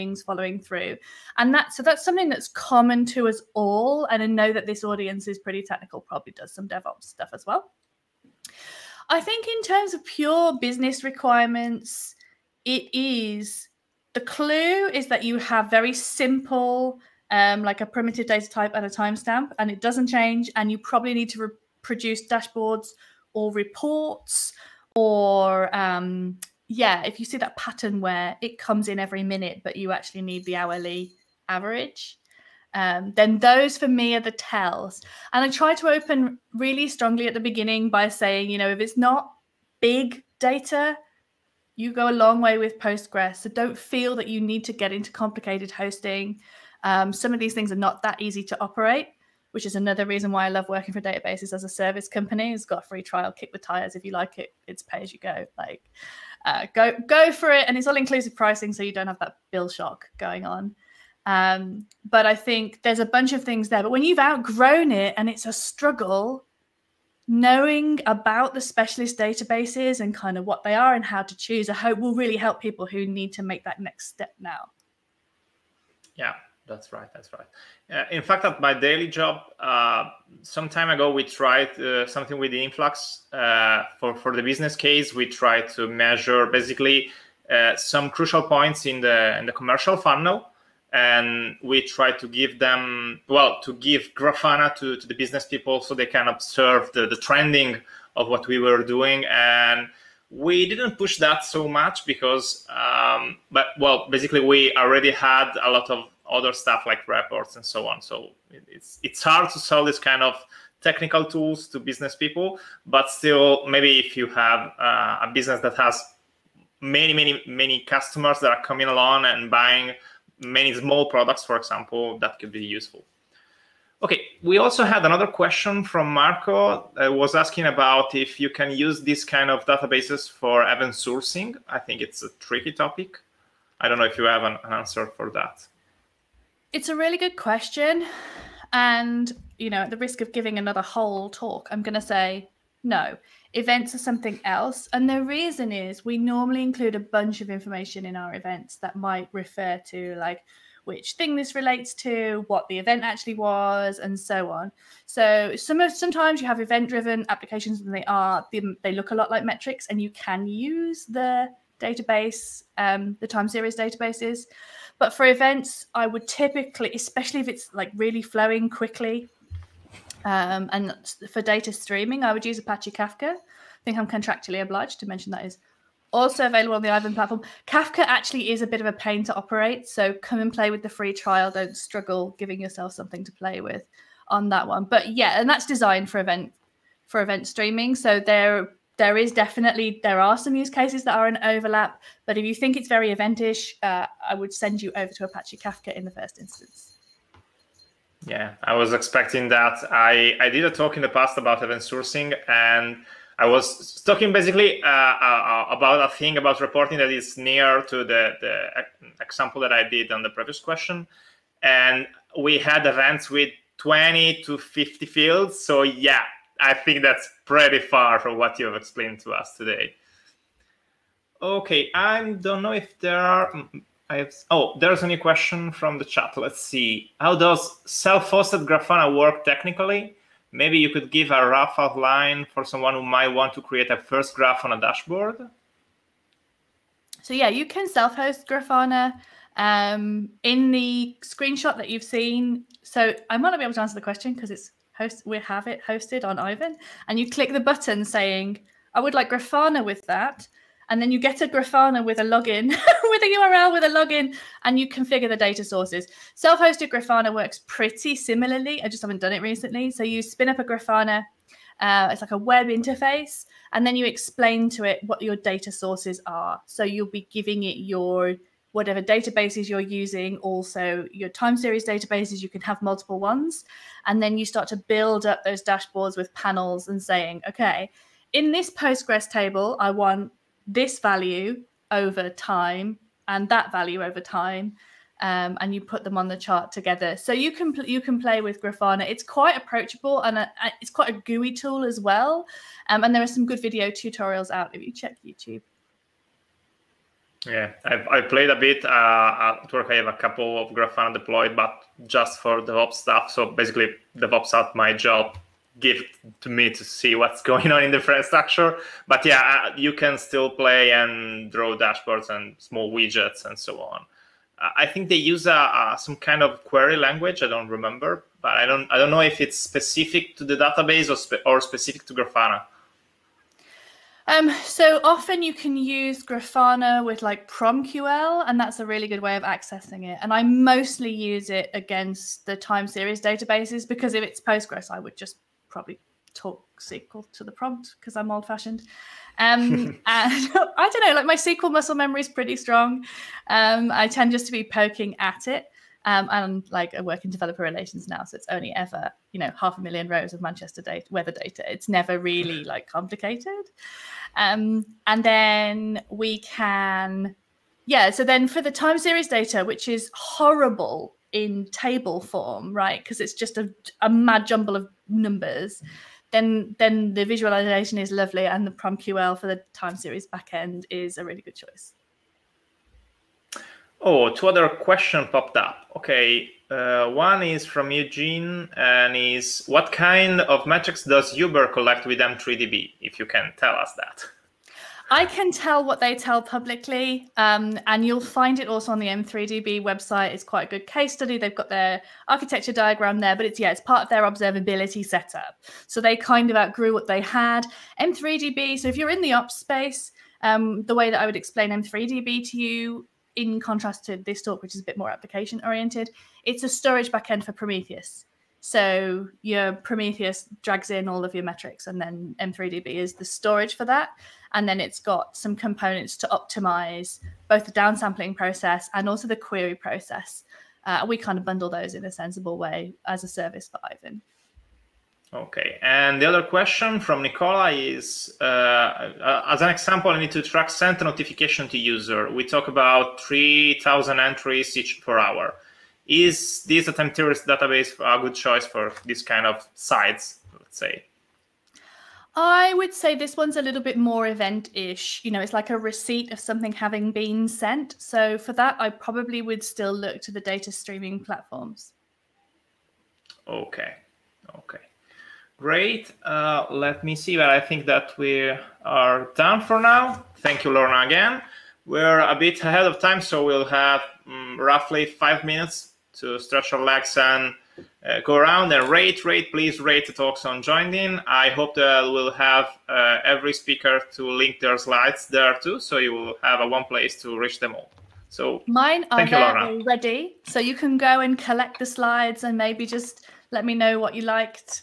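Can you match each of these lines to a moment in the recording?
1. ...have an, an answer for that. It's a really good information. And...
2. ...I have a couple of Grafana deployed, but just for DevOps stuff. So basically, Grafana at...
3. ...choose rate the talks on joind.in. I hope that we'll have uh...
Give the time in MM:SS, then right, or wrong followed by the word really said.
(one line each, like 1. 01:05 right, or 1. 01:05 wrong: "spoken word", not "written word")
1. 02:14 wrong: "question", not "information"
2. 04:59 wrong: "DevOps", not "Grafana"
3. 07:49 wrong: "please", not "choose".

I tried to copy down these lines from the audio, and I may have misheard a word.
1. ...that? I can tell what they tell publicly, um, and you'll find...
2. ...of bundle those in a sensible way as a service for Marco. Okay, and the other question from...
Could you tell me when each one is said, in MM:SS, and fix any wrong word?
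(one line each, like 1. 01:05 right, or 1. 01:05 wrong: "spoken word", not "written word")
1. 06:23 right
2. 07:01 wrong: "Aiven", not "Marco".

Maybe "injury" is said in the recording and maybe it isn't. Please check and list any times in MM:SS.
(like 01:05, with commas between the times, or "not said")
not said.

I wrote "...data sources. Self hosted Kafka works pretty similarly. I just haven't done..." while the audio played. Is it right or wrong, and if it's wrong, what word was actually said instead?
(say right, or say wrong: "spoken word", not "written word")
wrong: "Grafana", not "Kafka".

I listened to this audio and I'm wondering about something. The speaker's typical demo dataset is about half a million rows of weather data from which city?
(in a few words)
Manchester.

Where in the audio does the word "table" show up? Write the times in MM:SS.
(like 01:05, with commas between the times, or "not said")
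04:39, 06:01.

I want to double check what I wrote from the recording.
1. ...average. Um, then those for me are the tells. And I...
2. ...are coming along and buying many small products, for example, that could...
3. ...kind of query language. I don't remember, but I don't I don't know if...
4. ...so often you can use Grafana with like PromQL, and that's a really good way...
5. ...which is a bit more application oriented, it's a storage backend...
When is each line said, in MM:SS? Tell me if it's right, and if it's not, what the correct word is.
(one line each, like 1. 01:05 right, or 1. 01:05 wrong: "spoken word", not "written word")
1. 00:31 right
2. 01:58 right
3. 05:16 right
4. 05:24 right
5. 06:44 right.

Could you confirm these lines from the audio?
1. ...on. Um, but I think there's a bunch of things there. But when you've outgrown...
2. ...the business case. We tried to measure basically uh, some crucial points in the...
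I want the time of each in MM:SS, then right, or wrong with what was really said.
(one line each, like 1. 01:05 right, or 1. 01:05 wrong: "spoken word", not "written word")
1. 01:00 right
2. 01:24 right.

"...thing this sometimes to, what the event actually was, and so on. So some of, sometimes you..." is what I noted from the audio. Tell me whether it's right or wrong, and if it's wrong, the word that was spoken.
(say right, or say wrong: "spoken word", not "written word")
wrong: "relates", not "sometimes".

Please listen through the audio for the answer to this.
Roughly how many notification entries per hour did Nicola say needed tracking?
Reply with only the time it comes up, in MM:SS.
07:13.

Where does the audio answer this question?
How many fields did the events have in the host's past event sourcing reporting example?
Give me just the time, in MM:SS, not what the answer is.
03:33.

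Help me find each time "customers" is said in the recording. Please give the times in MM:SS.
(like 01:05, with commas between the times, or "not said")
01:57.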